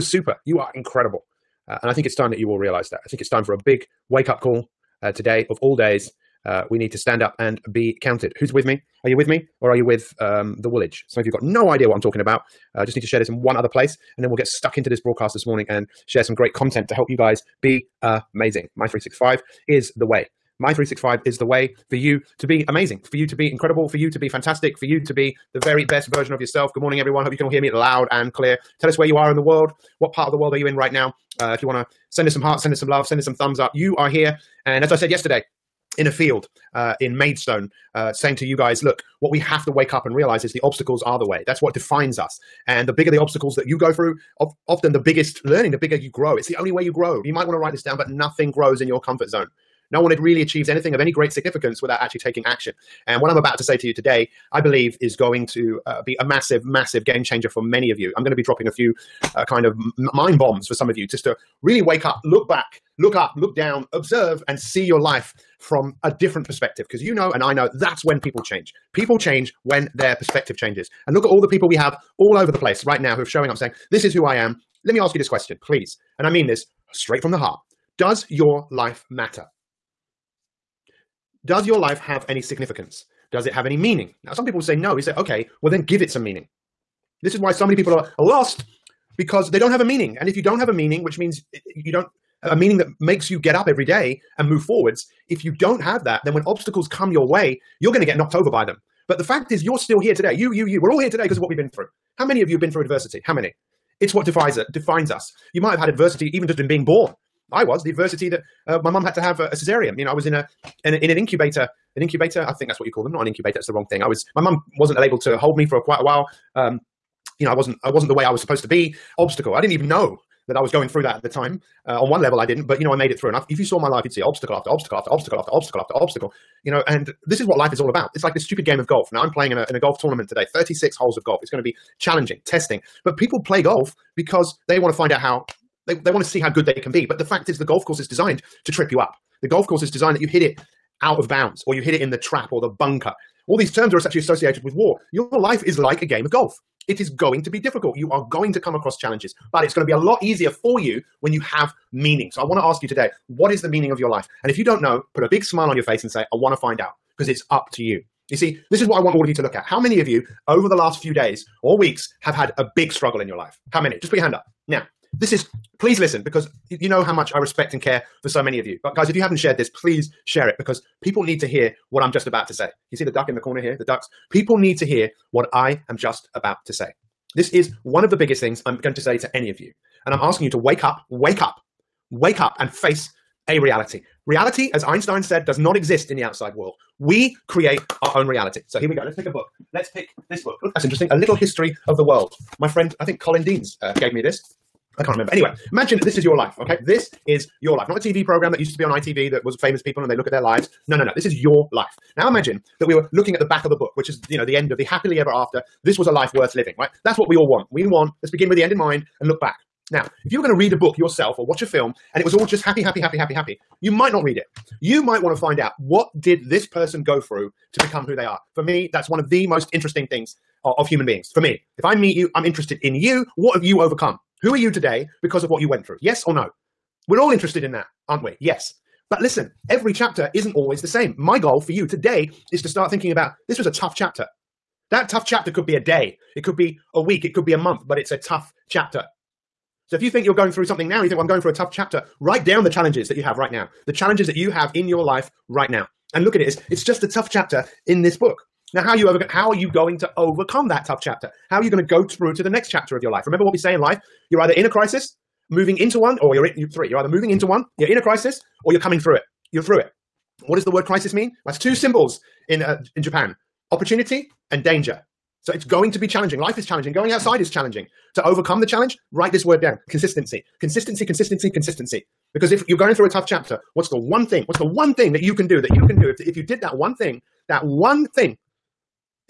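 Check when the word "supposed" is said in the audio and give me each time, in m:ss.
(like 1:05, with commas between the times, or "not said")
1:58.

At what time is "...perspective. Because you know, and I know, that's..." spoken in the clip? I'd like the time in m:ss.
1:06.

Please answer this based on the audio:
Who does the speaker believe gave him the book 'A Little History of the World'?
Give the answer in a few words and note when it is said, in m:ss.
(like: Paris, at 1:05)
Colin Deans, at 3:13.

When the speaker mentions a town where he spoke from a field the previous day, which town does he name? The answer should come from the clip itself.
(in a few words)
Maidstone.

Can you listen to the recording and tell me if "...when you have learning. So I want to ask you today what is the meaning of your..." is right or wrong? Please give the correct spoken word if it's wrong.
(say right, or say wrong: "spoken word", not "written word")
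wrong: "meaning", not "learning".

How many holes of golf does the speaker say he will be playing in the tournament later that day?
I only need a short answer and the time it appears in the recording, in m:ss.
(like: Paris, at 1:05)
36, at 2:10.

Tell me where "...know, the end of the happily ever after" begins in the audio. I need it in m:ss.
3:24.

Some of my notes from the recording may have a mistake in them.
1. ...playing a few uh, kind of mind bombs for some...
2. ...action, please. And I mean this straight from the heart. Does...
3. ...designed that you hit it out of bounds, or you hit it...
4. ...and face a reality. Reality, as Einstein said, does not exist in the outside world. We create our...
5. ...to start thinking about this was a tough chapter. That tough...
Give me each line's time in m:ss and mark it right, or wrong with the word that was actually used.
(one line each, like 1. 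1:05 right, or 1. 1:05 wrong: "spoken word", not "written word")
1. 0:58 wrong: "dropping", not "playing"
2. 1:15 wrong: "question", not "action"
3. 2:19 right
4. 3:02 right
5. 3:52 right.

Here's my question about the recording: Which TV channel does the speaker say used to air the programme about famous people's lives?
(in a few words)
ITV.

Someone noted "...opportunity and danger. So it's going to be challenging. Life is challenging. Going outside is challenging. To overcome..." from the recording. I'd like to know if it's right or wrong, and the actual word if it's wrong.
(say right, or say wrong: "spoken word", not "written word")
right.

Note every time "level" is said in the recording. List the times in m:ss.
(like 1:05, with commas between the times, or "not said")
2:02.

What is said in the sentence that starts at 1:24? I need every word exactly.
He say, okay, well, then give it some meaning.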